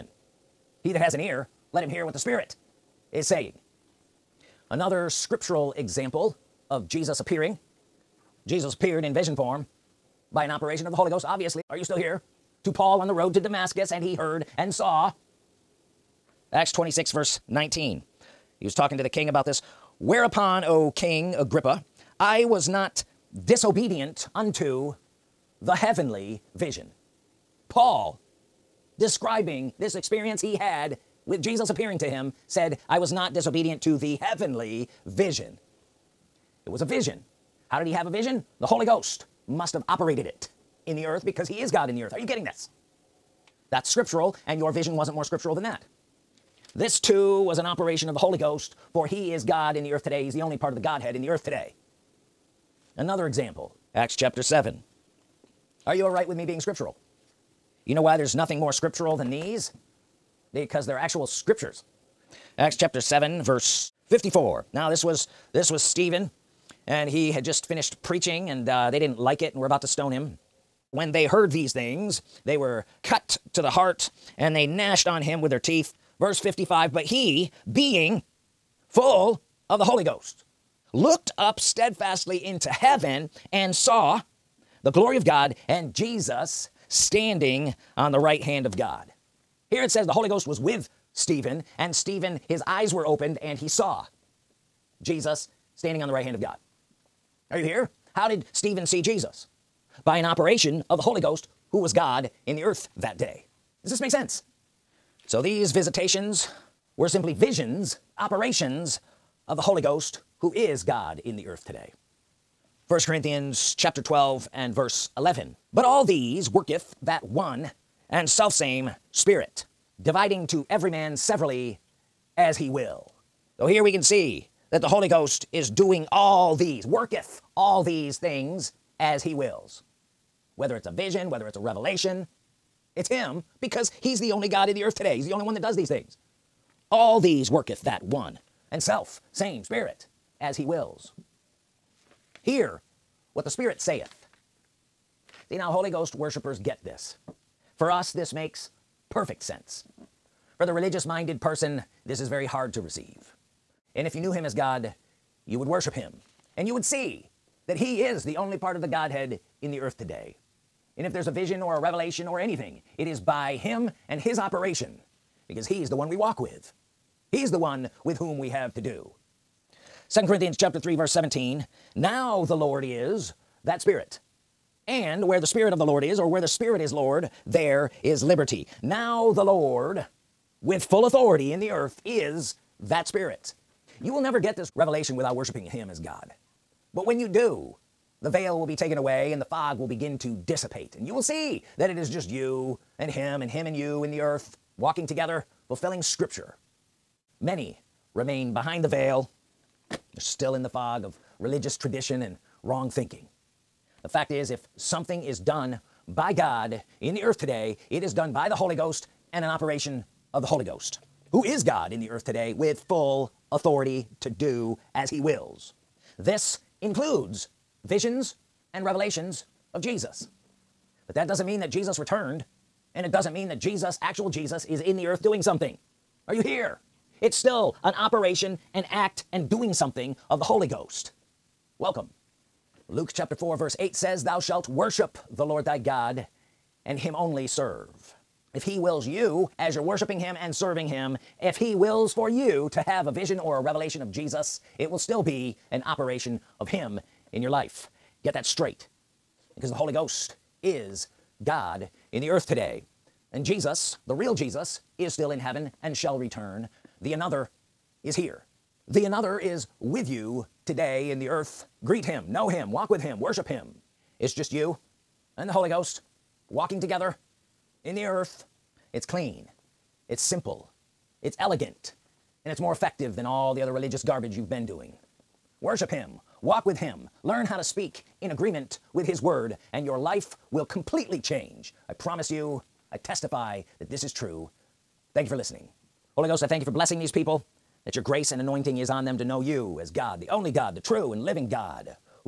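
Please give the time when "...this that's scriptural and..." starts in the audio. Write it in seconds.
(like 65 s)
42 s.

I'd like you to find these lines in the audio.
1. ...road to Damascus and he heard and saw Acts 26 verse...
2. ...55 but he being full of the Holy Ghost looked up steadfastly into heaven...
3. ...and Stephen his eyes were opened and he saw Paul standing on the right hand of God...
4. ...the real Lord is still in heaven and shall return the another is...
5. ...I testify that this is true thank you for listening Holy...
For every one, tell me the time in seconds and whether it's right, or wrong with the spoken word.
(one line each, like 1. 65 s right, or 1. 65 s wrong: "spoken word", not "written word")
1. 13 s right
2. 76 s right
3. 91 s wrong: "Jesus", not "Paul"
4. 254 s wrong: "Jesus", not "Lord"
5. 282 s right.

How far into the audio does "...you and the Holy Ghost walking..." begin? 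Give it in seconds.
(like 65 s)
264 s.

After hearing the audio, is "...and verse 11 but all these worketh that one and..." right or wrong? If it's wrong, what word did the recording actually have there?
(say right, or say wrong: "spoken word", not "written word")
right.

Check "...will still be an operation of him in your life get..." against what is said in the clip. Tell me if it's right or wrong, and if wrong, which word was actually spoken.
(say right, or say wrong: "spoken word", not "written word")
right.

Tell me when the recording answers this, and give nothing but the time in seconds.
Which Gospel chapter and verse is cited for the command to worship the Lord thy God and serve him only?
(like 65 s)
232 s.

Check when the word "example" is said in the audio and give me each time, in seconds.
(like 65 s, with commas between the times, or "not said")
5 s, 53 s.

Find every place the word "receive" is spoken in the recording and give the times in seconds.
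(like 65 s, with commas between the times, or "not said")
152 s.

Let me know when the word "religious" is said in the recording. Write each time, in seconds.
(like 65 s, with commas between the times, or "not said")
150 s, 201 s, 273 s.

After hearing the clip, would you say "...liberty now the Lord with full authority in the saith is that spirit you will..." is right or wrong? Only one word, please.
wrong.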